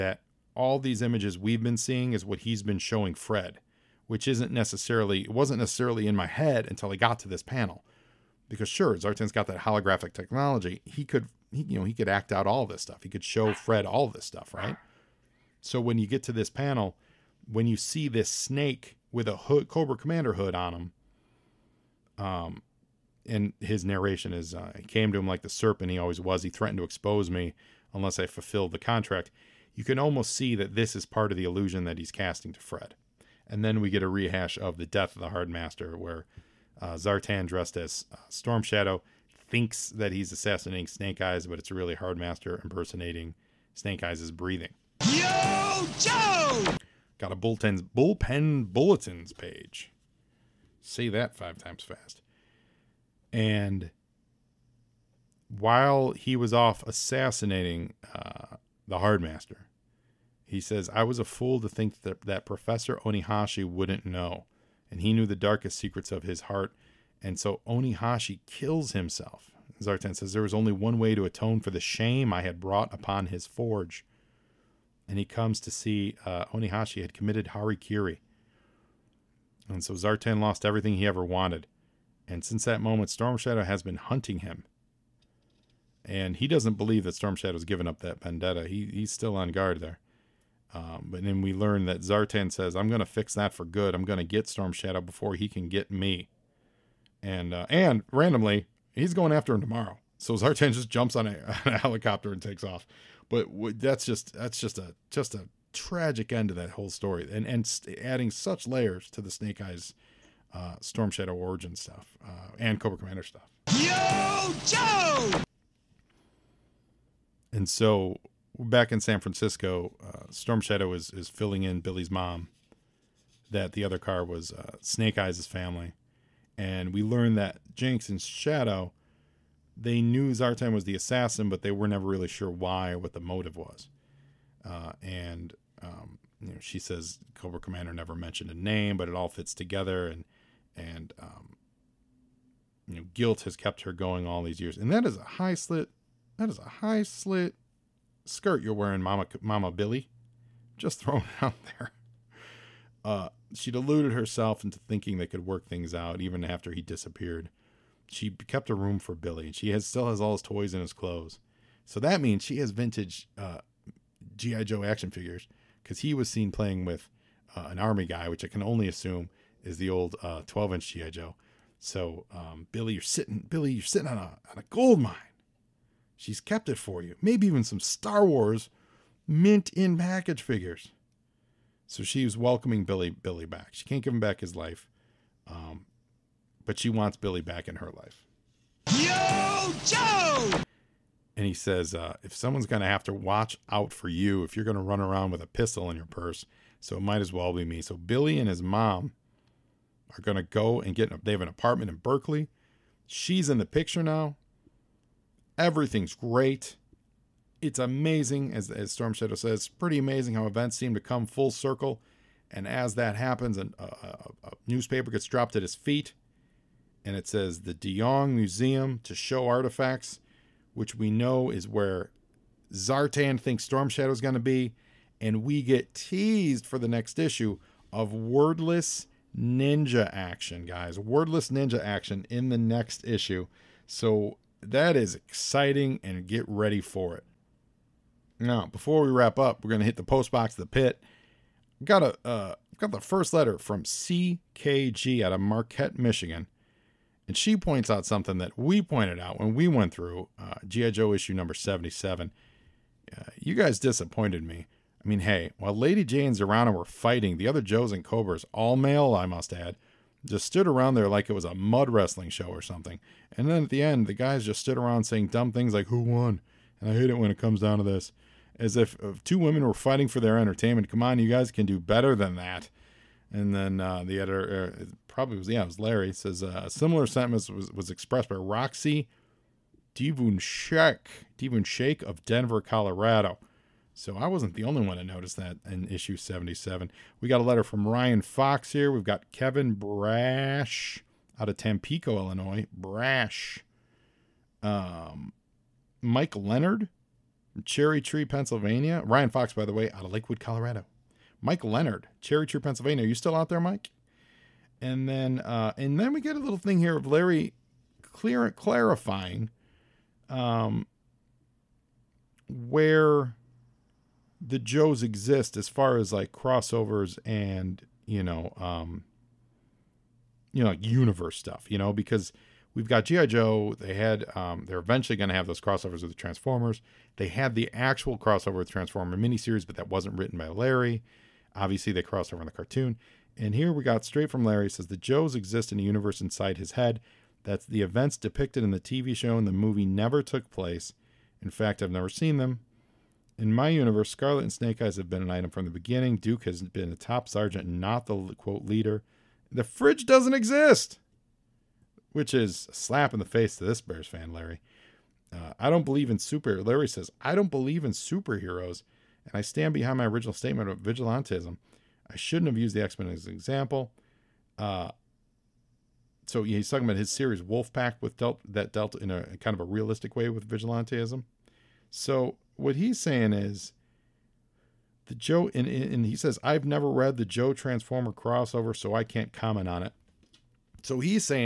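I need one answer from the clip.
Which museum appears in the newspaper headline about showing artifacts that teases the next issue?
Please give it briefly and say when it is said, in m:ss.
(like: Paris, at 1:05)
De Young Museum, at 3:37.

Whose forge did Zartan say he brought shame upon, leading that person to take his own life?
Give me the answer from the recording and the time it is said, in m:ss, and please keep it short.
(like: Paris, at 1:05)
Professor Onihashi, at 1:02.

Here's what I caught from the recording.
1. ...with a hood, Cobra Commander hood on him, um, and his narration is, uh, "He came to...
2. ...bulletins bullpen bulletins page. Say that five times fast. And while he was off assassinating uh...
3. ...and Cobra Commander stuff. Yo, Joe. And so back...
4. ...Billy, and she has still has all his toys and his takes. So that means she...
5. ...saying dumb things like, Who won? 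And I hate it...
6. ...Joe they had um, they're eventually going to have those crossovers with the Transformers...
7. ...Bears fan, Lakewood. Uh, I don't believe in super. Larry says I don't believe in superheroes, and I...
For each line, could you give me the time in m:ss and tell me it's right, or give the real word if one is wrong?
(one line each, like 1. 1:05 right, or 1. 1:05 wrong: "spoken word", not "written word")
1. 0:19 right
2. 0:47 right
3. 1:52 right
4. 2:39 wrong: "clothes", not "takes"
5. 4:25 right
6. 5:23 right
7. 5:53 wrong: "Larry", not "Lakewood".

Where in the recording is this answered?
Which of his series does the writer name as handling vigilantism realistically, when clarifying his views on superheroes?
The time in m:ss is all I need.
6:07.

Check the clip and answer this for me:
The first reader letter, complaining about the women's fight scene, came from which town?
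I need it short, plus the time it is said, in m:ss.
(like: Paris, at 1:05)
Marquette, Michigan, at 4:05.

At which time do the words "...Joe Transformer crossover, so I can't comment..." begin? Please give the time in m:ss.
6:17.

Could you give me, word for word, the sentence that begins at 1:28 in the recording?
He, he's still on guard there.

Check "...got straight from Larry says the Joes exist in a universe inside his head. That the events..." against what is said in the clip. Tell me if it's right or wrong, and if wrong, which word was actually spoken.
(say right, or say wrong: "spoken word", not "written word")
right.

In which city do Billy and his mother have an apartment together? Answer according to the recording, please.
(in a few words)
Berkeley.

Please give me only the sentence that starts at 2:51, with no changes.
So um, Billy, you're sitting, Billy, you're sitting on a on a gold mine.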